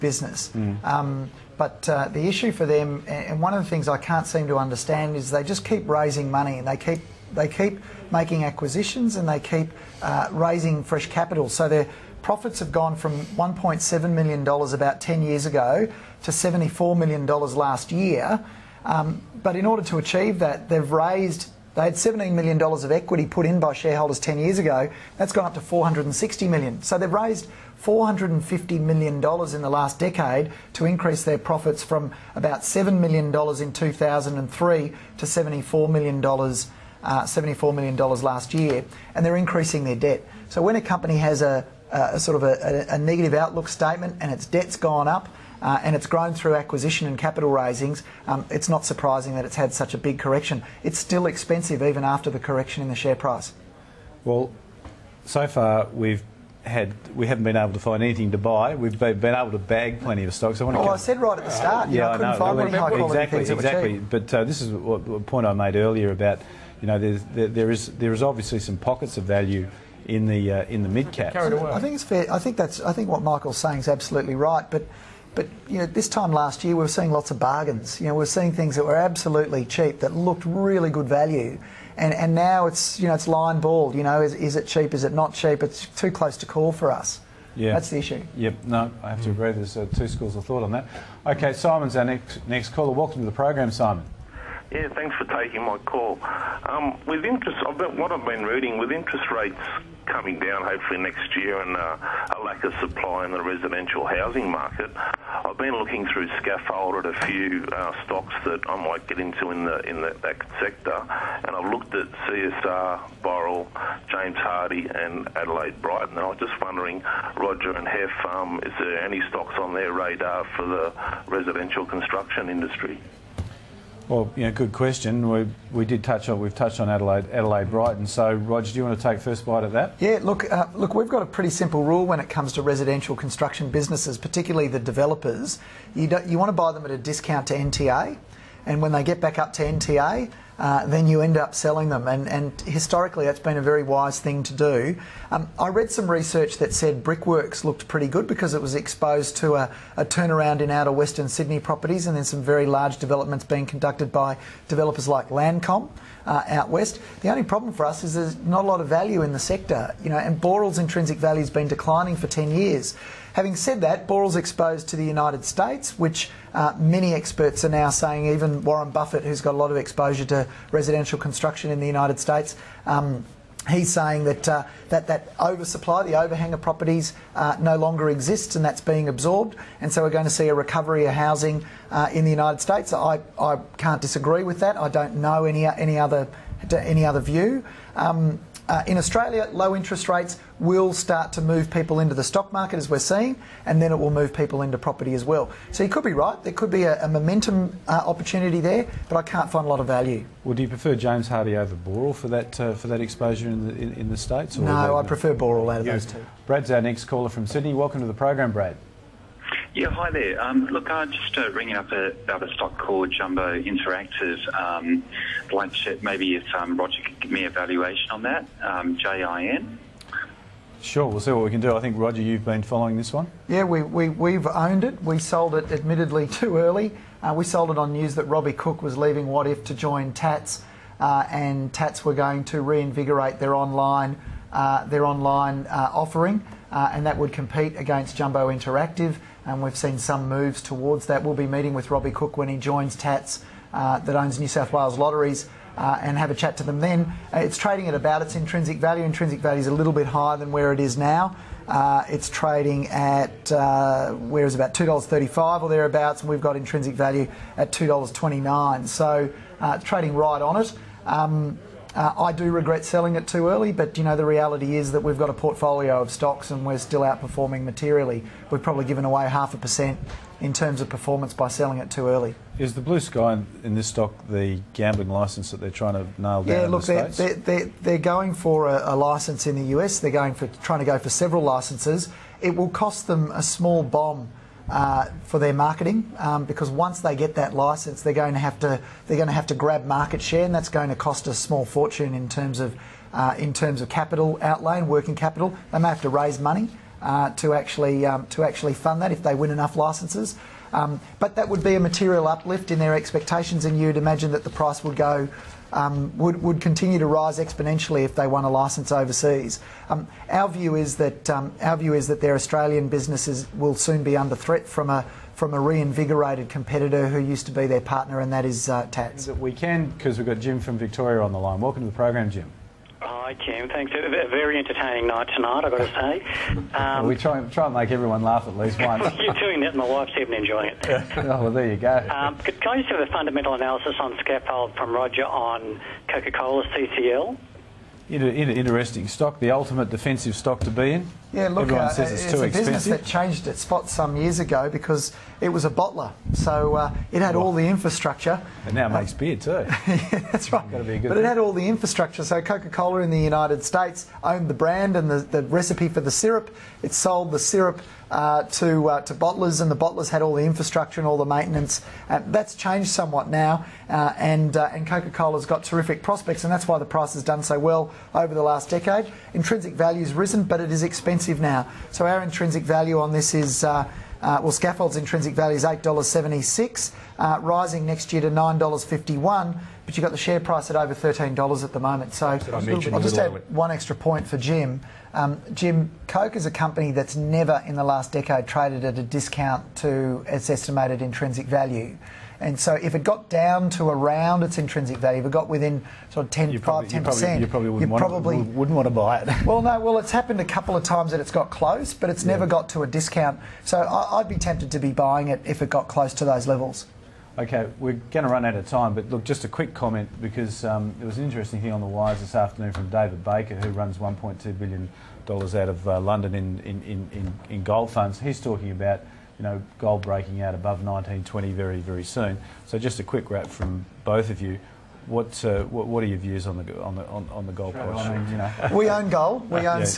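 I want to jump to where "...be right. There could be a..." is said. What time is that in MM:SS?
03:16.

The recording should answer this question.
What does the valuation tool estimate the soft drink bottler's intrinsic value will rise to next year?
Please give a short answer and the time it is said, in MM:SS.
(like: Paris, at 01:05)
$9.51, at 06:18.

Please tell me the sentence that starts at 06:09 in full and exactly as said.
Intrinsic value's risen, but it is expensive expensive now.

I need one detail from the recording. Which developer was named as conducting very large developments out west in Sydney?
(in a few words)
Landcom.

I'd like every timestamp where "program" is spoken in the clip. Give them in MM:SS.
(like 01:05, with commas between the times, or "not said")
01:33, 03:28, 05:21.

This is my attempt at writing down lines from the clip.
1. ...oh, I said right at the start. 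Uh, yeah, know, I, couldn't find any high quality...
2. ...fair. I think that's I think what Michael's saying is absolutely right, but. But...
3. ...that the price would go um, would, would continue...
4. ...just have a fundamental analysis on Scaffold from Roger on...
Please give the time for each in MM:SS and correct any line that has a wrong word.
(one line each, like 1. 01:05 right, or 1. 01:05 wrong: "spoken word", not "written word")
1. 01:00 right
2. 01:12 right
3. 05:04 right
4. 05:32 right.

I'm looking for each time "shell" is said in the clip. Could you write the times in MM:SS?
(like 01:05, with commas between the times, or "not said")
not said.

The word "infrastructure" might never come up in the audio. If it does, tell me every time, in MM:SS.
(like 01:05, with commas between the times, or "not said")
05:47, 05:51, 06:00.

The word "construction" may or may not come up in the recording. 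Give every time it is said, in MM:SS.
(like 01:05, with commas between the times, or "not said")
02:01, 02:13, 02:51.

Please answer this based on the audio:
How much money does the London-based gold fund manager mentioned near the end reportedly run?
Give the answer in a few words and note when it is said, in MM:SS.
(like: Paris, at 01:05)
$1.2 billion, at 06:53.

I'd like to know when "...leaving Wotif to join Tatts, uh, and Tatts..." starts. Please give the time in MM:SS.
03:48.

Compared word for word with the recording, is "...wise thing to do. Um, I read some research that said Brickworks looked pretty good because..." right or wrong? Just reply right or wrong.
right.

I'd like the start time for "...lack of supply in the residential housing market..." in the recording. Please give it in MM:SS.
01:42.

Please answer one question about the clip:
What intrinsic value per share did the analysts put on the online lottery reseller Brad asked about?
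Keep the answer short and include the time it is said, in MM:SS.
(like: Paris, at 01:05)
$2.29, at 04:17.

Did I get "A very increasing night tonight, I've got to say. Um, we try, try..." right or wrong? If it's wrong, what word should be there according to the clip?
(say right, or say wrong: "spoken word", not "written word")
wrong: "entertaining", not "increasing".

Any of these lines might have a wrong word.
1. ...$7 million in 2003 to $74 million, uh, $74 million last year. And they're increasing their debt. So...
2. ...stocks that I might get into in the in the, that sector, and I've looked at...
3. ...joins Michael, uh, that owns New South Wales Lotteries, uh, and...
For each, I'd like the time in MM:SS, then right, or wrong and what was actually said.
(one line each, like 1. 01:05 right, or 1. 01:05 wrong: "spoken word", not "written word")
1. 00:32 right
2. 01:48 right
3. 04:02 wrong: "Tatts", not "Michael".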